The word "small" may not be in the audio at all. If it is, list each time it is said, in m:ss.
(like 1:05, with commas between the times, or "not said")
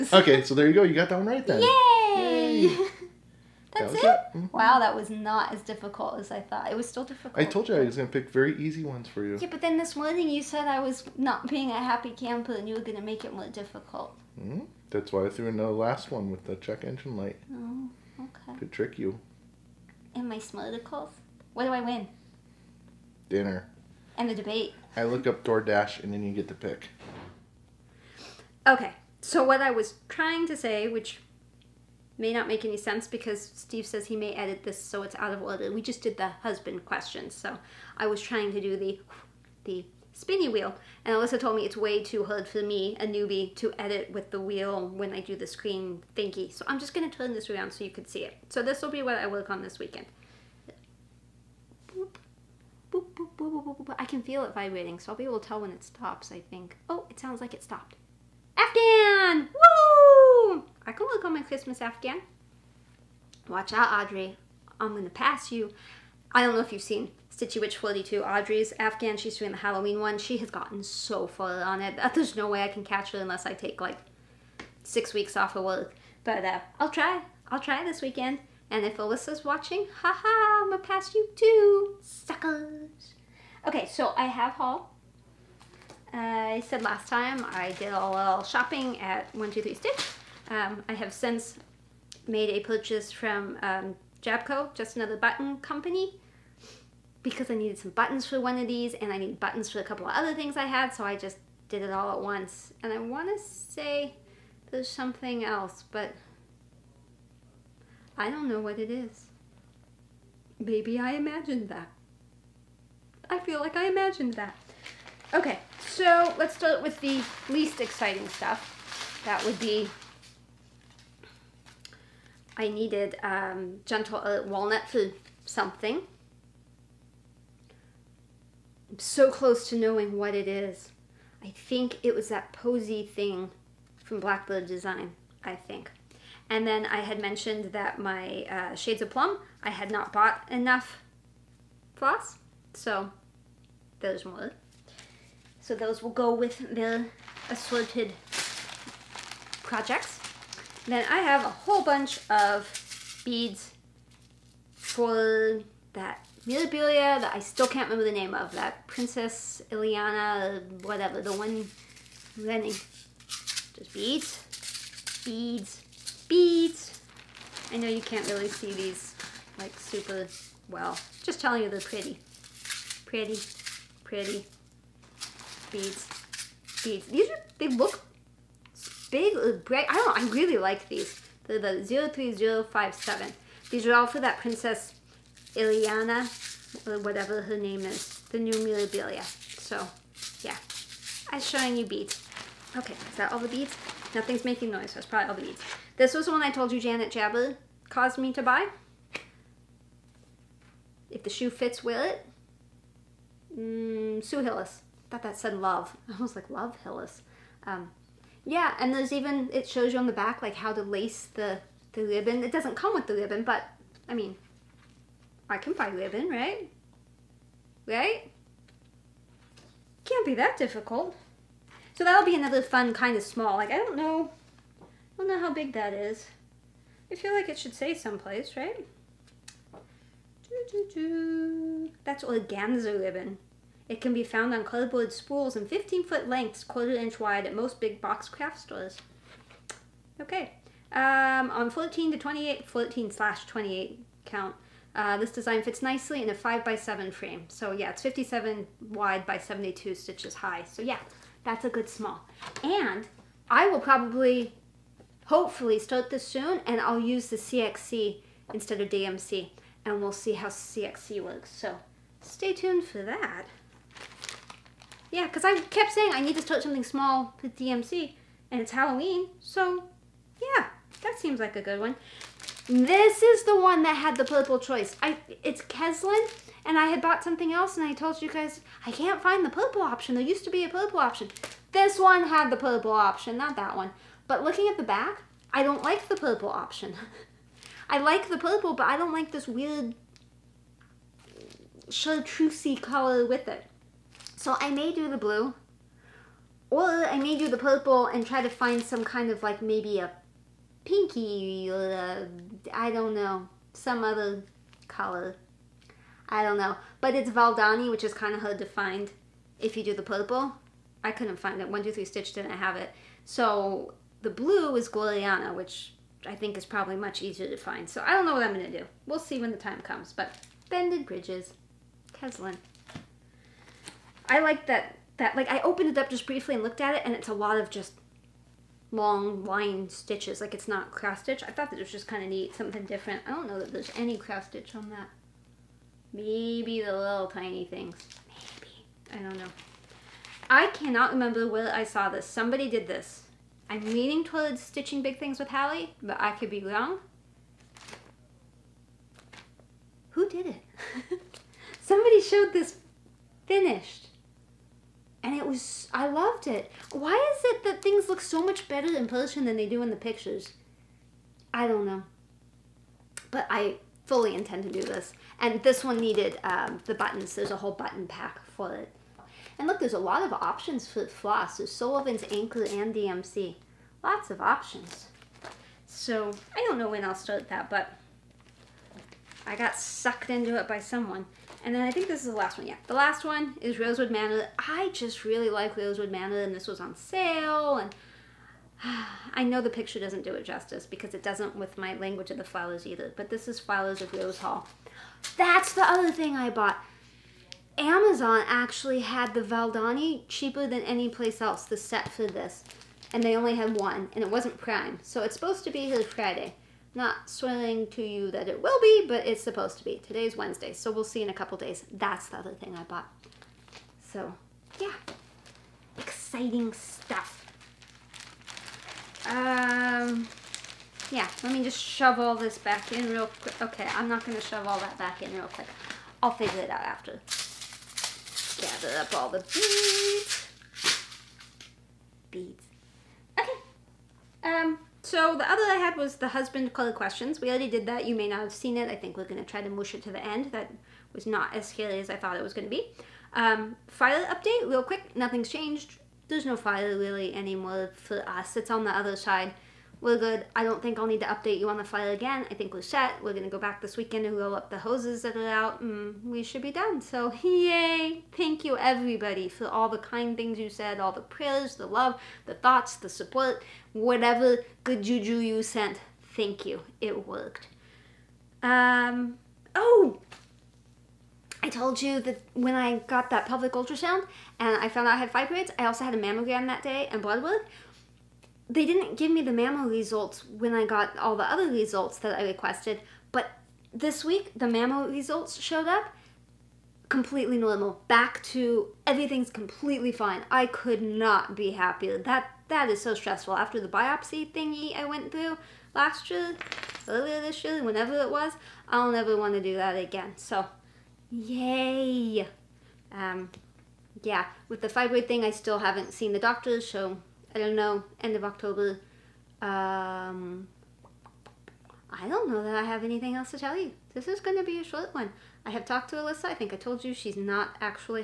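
3:43, 4:11, 4:26.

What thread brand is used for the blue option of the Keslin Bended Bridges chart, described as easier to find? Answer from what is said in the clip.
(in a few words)
Gloriana.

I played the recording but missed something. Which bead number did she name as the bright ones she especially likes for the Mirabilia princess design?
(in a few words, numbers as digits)
03057.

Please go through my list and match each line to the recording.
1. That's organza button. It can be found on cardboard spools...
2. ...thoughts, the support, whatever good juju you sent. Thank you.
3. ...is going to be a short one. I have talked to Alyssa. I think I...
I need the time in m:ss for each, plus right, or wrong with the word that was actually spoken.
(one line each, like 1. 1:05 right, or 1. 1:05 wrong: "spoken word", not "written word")
1. 3:52 wrong: "ribbon", not "button"
2. 7:42 right
3. 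8:34 right.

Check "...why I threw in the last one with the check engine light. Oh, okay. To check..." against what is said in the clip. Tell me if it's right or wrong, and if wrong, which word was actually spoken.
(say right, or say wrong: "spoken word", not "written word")
wrong: "trick", not "check".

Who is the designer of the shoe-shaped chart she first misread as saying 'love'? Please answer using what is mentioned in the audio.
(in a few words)
Sue Hillis.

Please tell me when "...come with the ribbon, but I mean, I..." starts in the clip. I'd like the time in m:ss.
3:32.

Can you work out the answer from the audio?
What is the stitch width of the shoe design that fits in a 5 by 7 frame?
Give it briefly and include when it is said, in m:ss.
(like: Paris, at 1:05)
57, at 4:08.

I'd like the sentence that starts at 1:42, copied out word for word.
And I want to say there's something else, but I don't know what it is.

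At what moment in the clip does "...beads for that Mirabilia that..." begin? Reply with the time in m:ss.
2:33.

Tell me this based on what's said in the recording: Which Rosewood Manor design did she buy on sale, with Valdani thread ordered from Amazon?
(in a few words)
Flowers of Rose Hall.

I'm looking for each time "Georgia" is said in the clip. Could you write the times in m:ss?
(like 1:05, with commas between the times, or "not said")
not said.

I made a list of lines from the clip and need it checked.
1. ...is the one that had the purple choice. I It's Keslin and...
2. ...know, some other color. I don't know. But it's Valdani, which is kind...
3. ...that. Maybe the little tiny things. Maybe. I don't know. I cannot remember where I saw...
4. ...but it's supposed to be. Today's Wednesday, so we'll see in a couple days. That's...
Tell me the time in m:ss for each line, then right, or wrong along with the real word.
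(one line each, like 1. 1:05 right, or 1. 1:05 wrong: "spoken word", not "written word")
1. 4:33 right
2. 5:03 right
3. 5:34 right
4. 6:49 right.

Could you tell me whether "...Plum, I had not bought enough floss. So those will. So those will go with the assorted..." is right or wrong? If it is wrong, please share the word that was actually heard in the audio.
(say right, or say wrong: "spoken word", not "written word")
right.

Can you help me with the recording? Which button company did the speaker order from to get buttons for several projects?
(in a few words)
Jabco.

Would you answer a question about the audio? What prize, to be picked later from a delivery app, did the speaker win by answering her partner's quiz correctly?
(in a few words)
Dinner.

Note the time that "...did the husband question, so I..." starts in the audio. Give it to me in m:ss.
0:36.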